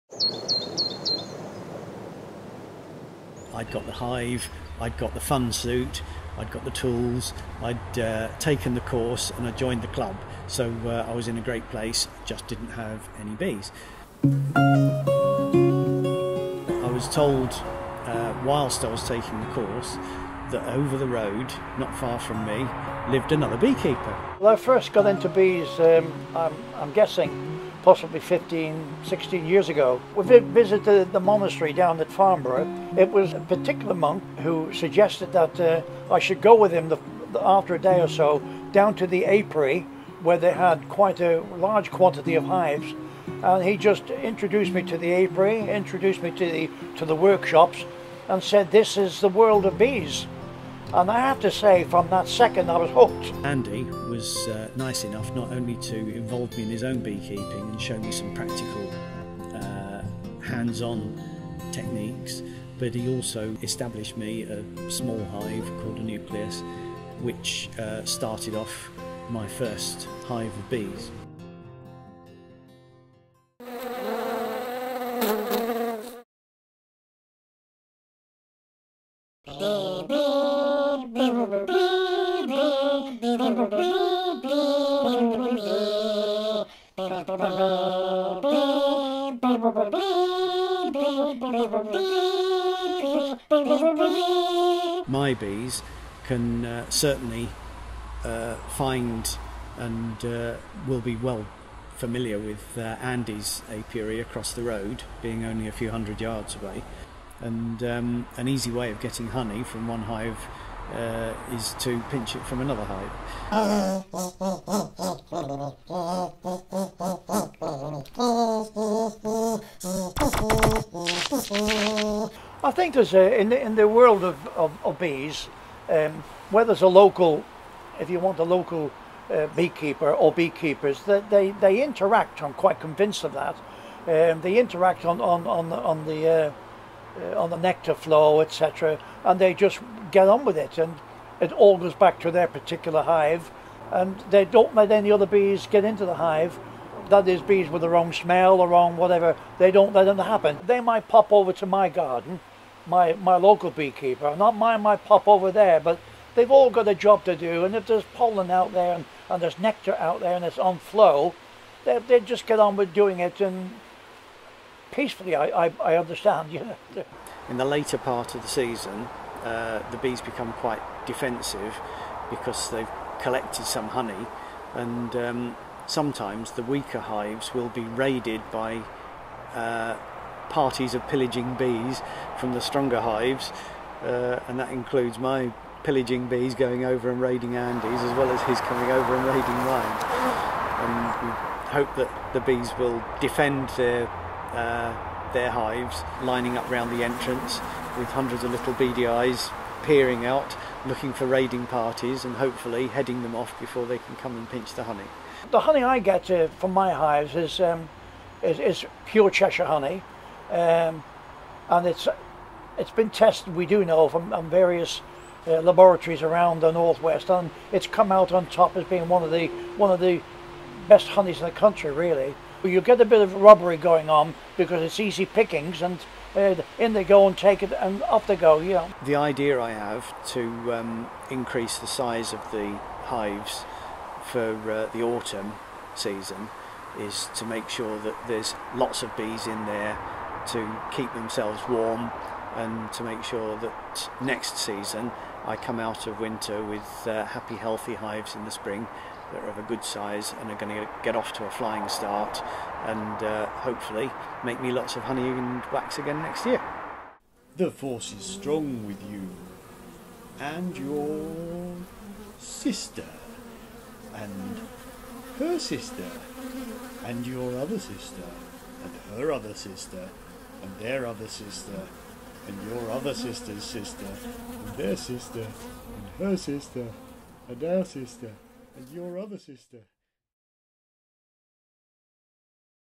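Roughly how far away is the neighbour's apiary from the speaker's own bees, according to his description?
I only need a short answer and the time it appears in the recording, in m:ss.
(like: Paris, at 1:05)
a few hundred yards, at 1:45.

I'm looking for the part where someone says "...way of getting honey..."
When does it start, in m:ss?
1:48.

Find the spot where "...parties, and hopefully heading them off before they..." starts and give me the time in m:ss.
3:21.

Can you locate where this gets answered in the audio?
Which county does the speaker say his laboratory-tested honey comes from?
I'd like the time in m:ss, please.
3:29.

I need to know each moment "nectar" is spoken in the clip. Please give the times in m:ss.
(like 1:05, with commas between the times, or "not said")
2:17, 2:39.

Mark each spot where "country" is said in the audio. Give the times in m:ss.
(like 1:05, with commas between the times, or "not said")
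3:41.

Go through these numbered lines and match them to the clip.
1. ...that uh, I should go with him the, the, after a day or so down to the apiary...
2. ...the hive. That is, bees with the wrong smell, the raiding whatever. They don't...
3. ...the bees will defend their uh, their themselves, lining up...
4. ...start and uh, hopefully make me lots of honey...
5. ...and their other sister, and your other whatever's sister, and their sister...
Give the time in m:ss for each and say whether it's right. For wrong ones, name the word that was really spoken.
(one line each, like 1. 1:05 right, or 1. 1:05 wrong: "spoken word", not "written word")
1. 0:35 right
2. 2:26 wrong: "wrong", not "raiding"
3. 3:12 wrong: "hives", not "themselves"
4. 4:11 right
5. 4:30 wrong: "sister", not "whatever".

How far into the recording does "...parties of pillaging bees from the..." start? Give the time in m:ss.
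3:00.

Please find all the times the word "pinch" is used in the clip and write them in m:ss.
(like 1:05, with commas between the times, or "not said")
1:52, 3:24.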